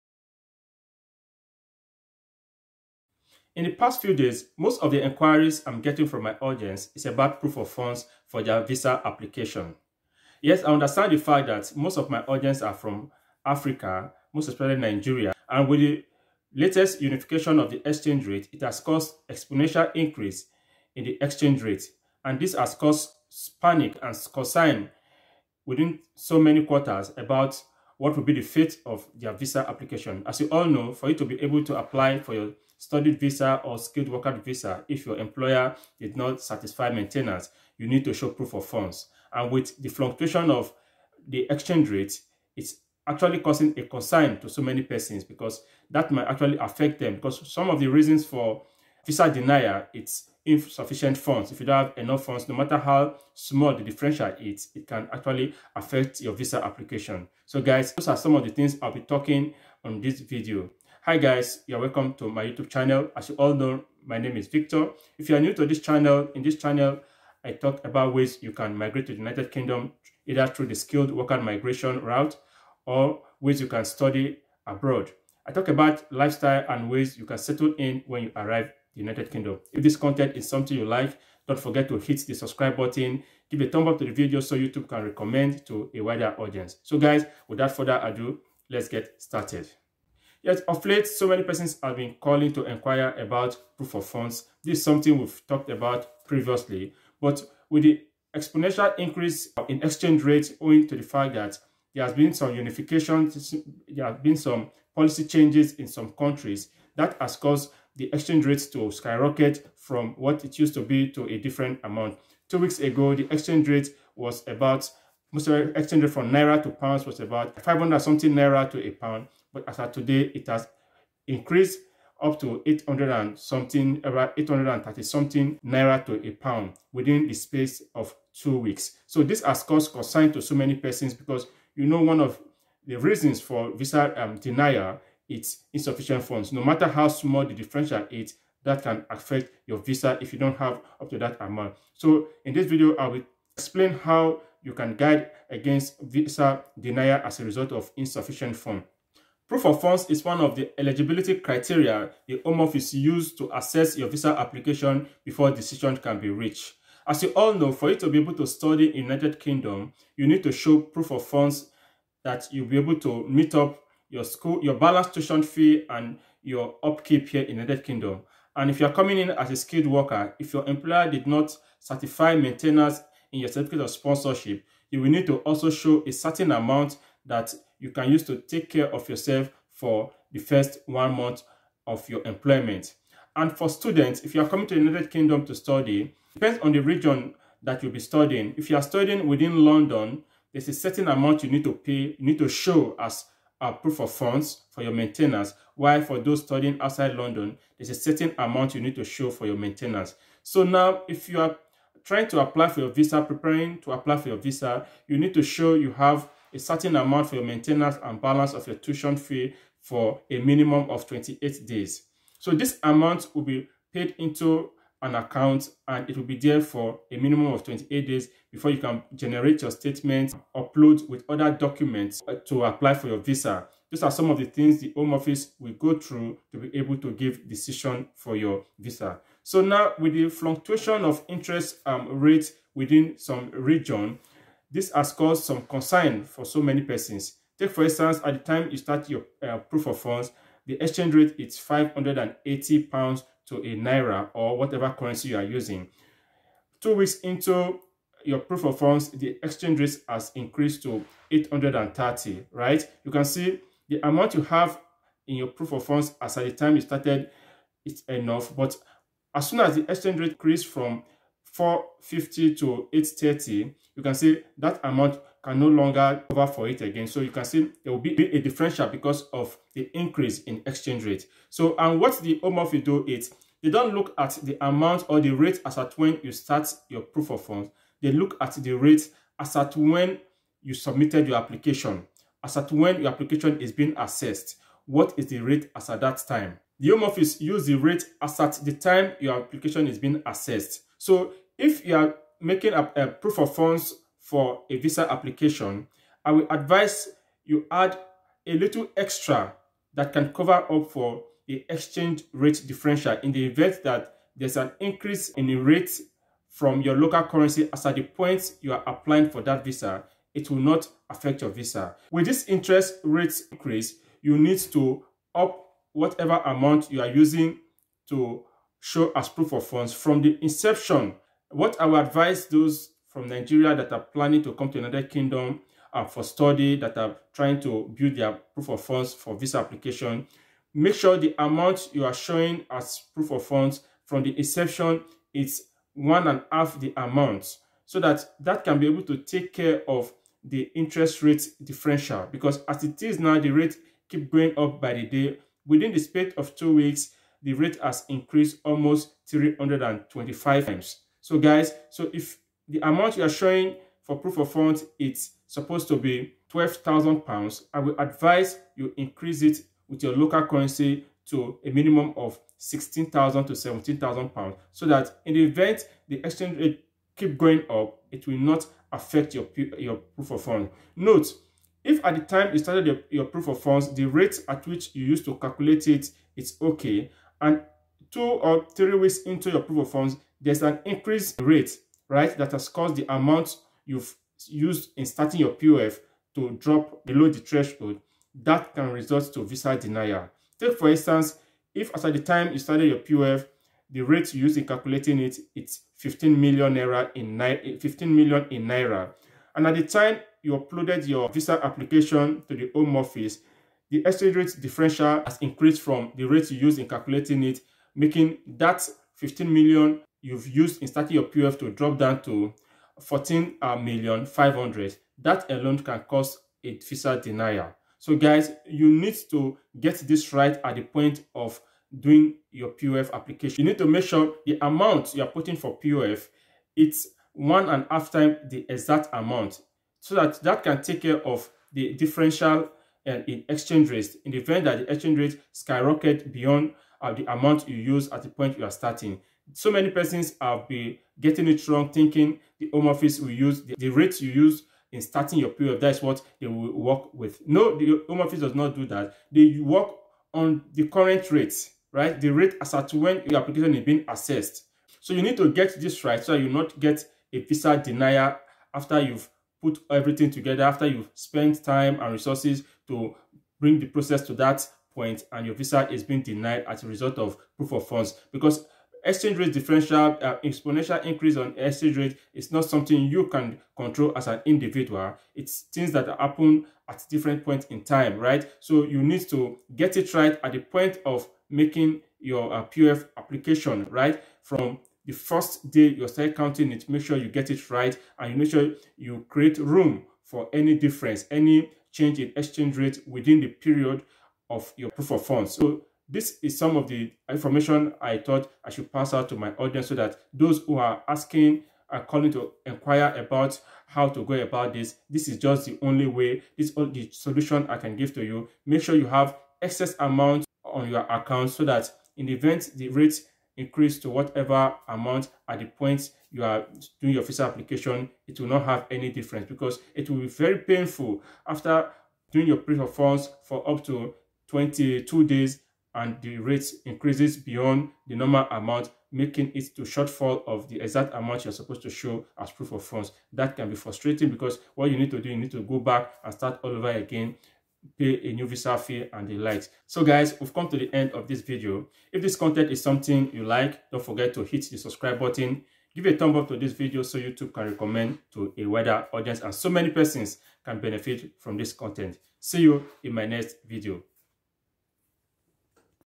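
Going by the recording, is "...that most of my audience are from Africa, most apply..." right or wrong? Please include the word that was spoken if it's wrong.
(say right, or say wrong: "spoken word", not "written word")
wrong: "especially", not "apply".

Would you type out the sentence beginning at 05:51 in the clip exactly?
So guys, so if the amount you are showing for proof of funds, it's supposed to be 12,000 pounds.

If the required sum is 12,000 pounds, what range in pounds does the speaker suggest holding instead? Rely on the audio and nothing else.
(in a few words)
16,000 to 17,000 pounds.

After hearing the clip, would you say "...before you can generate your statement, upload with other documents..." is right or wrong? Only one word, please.
right.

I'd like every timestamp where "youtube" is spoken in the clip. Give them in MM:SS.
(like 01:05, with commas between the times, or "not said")
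01:02, 01:24, 09:07.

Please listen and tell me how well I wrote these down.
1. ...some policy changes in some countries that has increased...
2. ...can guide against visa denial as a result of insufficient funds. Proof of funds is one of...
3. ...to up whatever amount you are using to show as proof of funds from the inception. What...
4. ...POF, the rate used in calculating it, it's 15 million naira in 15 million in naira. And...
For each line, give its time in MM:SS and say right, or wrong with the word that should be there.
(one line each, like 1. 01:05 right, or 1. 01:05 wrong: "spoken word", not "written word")
1. 01:44 wrong: "caused", not "increased"
2. 02:24 right
3. 05:14 right
4. 06:32 right.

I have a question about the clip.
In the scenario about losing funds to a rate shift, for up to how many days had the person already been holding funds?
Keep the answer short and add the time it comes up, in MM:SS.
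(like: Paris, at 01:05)
22, at 08:44.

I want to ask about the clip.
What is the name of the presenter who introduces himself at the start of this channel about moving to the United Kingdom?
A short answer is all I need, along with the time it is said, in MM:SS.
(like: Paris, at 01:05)
Victor, at 01:04.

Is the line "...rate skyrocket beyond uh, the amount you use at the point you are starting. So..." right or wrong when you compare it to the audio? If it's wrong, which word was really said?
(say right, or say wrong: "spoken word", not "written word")
right.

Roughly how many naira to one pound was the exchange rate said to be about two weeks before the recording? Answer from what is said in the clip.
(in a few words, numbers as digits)
500 something.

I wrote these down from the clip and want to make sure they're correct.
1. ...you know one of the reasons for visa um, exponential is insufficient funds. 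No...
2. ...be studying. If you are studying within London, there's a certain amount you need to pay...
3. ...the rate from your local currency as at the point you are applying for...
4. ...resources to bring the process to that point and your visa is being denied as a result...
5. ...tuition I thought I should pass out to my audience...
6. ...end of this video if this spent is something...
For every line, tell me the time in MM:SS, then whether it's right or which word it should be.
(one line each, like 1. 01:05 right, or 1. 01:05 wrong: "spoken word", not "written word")
1. 02:11 wrong: "denial", not "exponential"
2. 03:07 right
3. 05:05 right
4. 07:42 right
5. 08:17 wrong: "information", not "tuition"
6. 09:00 wrong: "content", not "spent".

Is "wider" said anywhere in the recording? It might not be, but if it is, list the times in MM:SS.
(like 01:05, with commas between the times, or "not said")
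01:26, 09:08.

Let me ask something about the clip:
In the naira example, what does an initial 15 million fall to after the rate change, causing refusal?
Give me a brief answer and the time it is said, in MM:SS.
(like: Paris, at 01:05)
14.5 million, at 06:53.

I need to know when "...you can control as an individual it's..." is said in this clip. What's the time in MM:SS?
07:53.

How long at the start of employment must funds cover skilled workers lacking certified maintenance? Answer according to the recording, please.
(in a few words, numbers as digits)
first one month.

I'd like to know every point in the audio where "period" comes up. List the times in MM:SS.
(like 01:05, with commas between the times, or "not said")
07:25, 08:13.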